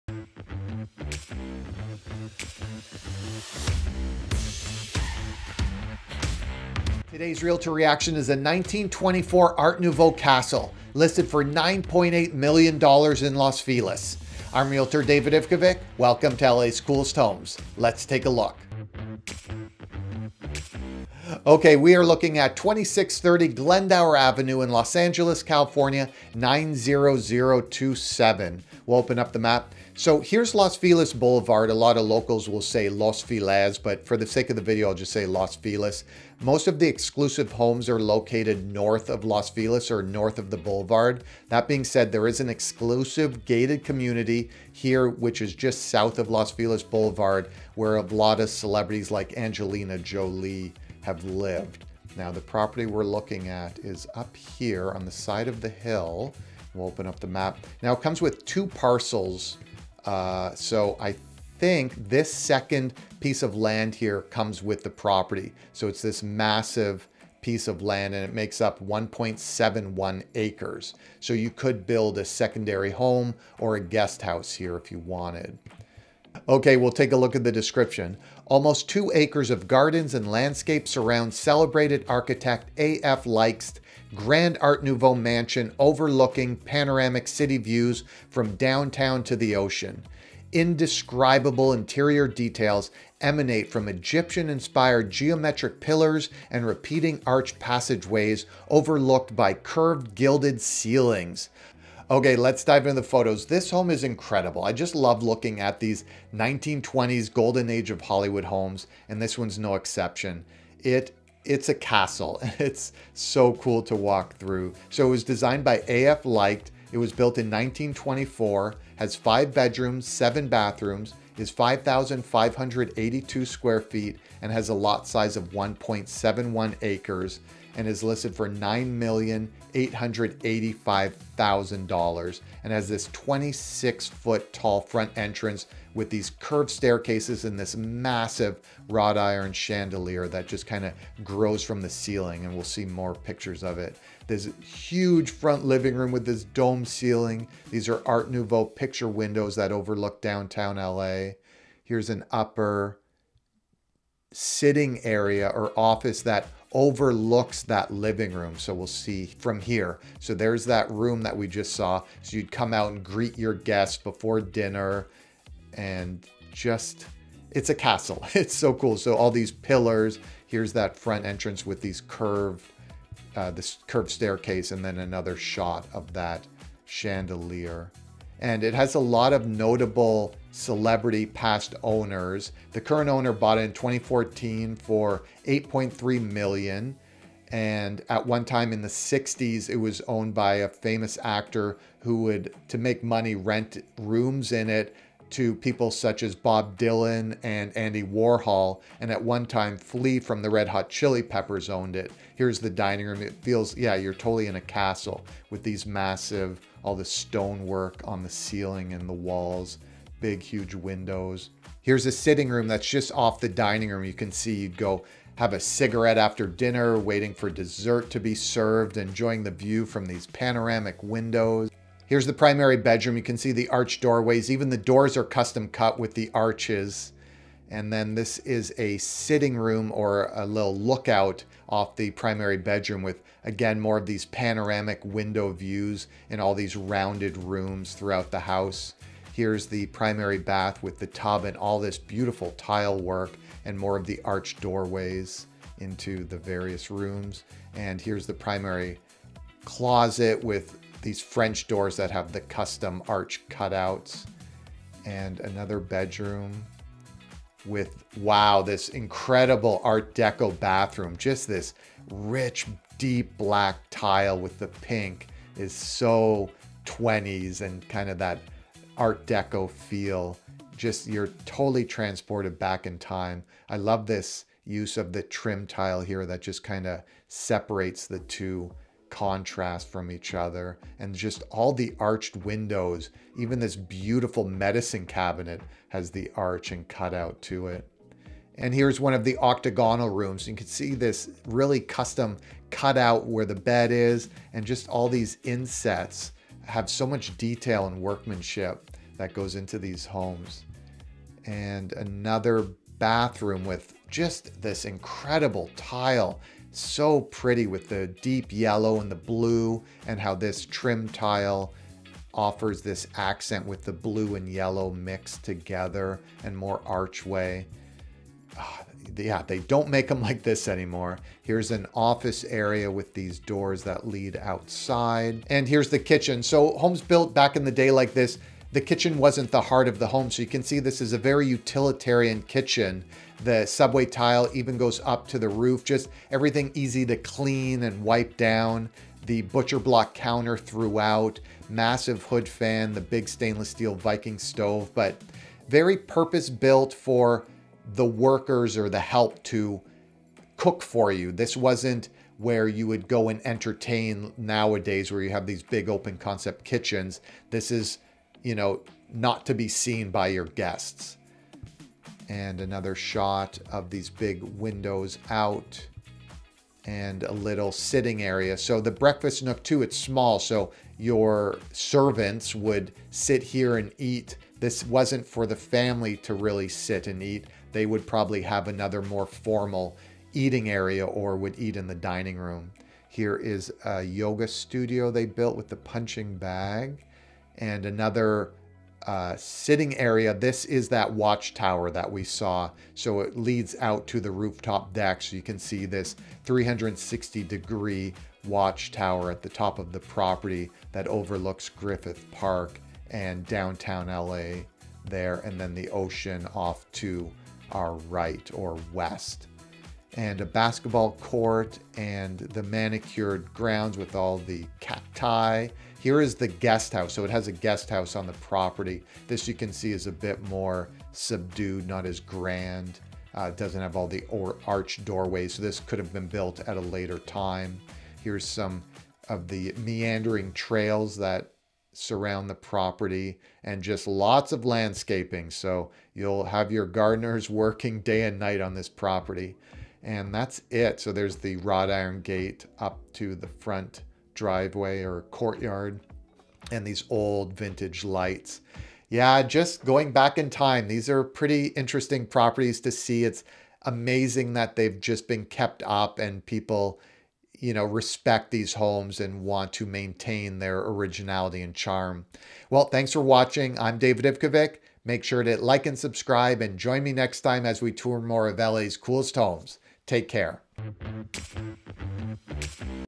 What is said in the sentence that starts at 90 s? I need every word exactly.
Indescribable interior details emanate from Egyptian inspired geometric pillars and repeating arch passageways overlooked by curved gilded ceilings.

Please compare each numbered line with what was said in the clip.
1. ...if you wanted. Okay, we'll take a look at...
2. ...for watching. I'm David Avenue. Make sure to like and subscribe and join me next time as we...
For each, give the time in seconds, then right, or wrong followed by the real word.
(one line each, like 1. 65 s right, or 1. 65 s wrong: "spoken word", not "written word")
1. 74 s right
2. 463 s wrong: "Ivkovic", not "Avenue".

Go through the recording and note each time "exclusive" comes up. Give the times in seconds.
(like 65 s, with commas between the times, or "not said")
36 s, 42 s.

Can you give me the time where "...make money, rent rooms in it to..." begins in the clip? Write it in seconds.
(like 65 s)
192 s.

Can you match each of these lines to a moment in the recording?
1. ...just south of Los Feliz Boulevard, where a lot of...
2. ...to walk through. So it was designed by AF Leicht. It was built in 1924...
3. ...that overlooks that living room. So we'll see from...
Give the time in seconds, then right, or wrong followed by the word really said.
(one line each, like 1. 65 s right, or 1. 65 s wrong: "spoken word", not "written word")
1. 45 s right
2. 113 s right
3. 156 s right.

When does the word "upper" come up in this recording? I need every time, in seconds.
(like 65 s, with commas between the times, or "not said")
152 s.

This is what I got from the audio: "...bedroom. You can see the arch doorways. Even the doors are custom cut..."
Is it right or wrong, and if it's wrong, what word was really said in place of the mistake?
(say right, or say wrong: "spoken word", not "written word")
right.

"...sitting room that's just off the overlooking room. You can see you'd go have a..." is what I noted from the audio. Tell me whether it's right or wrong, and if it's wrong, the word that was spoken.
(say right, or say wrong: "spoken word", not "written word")
wrong: "dining", not "overlooking".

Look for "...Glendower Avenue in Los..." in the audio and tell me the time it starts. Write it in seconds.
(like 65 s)
23 s.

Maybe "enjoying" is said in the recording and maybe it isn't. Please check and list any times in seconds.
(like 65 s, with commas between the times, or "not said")
218 s.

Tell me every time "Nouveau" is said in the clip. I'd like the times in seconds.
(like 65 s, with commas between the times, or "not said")
9 s, 84 s, 148 s.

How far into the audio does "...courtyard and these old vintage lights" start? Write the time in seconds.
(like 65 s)
445 s.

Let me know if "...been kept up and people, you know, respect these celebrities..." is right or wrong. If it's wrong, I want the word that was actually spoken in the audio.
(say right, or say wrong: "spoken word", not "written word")
wrong: "homes", not "celebrities".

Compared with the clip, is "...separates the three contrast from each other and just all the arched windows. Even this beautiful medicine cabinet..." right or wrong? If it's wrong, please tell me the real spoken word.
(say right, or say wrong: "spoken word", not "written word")
wrong: "two", not "three".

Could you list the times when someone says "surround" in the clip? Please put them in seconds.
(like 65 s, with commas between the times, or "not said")
80 s, 431 s.